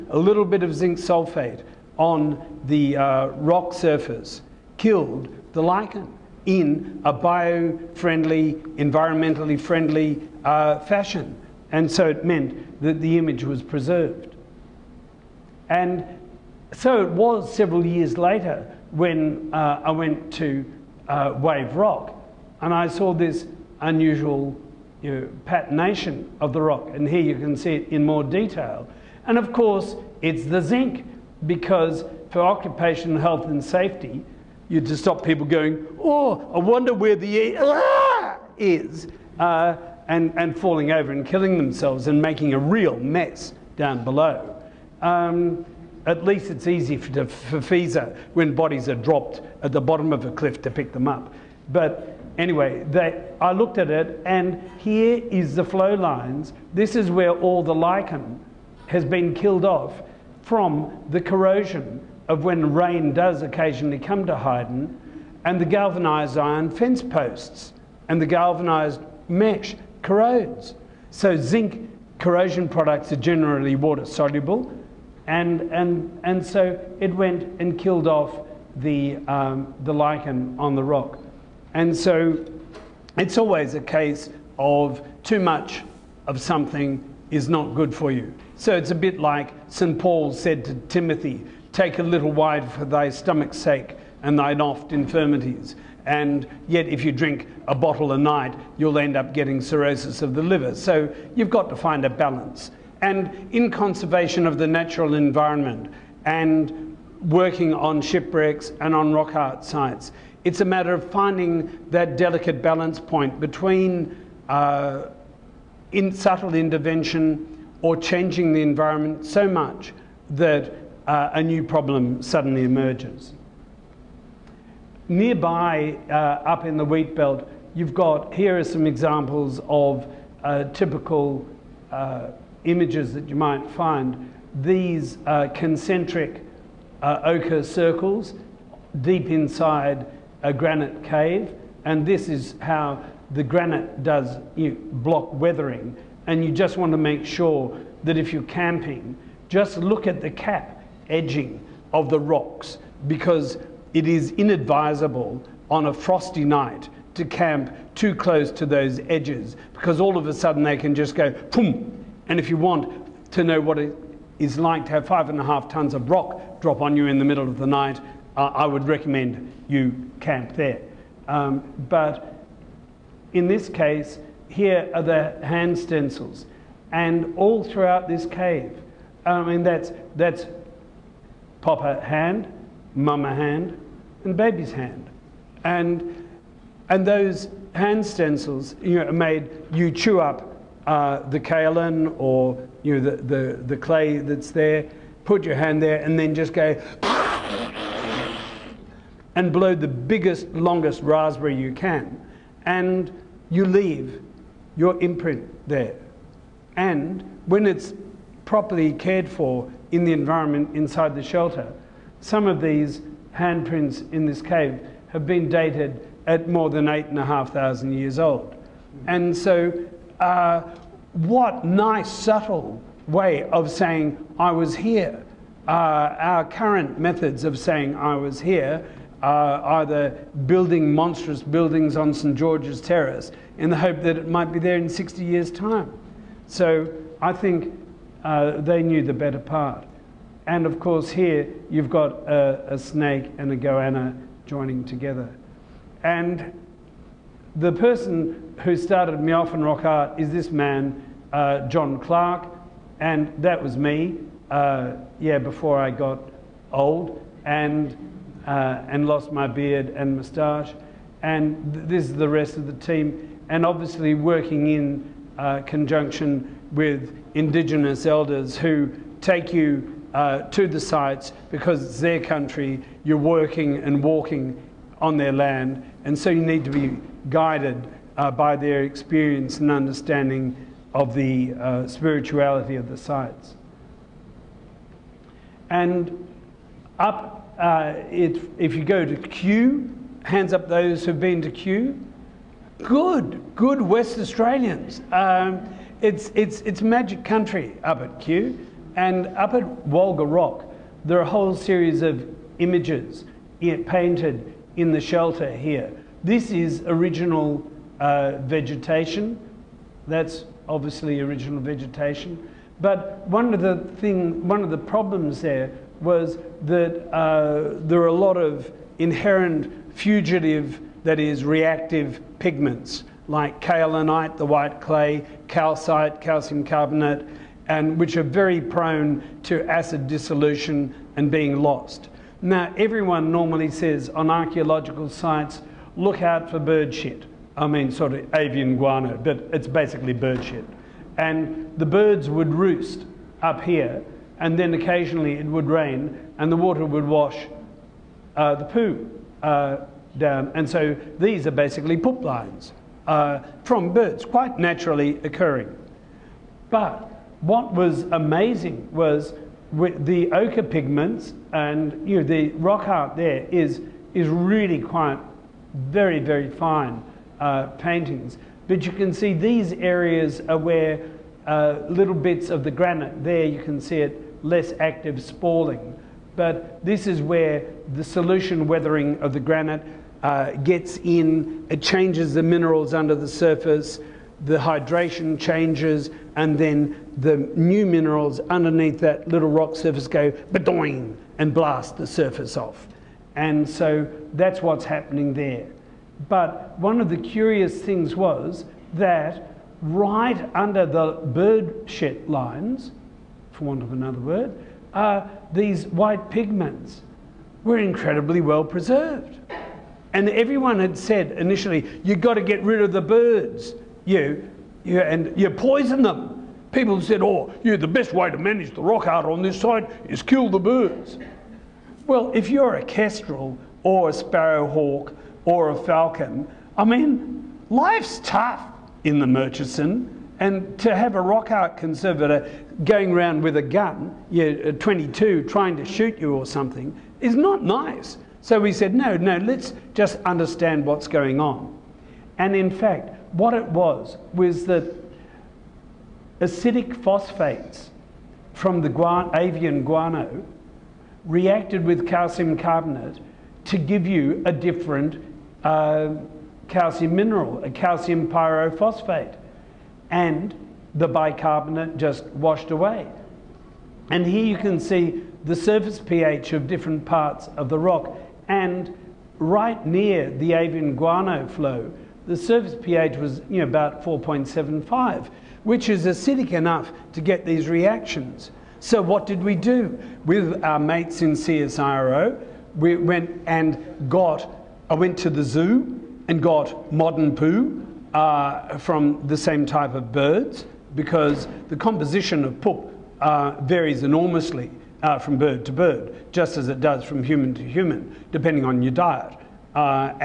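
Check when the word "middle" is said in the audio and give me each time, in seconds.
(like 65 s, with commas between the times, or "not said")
167 s.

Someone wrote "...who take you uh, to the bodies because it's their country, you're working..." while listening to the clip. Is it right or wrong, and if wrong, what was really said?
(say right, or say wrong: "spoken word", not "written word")
wrong: "sites", not "bodies".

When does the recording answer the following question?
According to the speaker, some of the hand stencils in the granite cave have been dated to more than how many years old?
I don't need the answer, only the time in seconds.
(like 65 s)
216 s.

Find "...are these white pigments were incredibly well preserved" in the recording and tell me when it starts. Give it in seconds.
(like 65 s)
404 s.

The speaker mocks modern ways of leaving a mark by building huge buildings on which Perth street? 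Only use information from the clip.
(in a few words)
St George's Terrace.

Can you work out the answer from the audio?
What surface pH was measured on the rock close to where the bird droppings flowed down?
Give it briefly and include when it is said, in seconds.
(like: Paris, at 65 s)
4.75, at 474 s.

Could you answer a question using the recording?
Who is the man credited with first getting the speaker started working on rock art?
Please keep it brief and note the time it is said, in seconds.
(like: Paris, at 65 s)
John Clark, at 251 s.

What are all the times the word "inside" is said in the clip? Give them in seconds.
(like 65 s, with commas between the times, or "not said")
139 s, 210 s.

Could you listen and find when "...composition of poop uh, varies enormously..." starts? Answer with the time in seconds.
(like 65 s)
491 s.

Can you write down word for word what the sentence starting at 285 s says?
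And up, uh, it, if you go to Cue, hands up those who've been to Cue.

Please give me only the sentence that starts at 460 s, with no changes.
And the bicarbonate just washed away.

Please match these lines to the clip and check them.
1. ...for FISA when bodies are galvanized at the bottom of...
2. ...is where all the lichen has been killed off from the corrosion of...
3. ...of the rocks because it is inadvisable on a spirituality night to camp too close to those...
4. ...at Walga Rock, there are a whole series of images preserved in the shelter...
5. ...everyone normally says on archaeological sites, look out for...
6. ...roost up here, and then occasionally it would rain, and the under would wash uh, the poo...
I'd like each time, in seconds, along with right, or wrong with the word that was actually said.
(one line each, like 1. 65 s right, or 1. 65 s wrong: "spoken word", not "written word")
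1. 47 s wrong: "dropped", not "galvanized"
2. 56 s right
3. 151 s wrong: "frosty", not "spirituality"
4. 299 s wrong: "painted", not "preserved"
5. 332 s right
6. 342 s wrong: "water", not "under".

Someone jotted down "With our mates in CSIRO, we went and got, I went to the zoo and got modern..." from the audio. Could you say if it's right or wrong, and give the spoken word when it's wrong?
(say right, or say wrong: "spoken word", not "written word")
right.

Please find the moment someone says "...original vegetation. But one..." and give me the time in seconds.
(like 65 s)
311 s.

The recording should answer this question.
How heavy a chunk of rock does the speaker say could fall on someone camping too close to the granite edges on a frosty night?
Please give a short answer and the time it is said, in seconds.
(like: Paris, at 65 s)
5 and a half tons, at 165 s.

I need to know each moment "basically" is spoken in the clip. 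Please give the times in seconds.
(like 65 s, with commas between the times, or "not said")
339 s, 351 s.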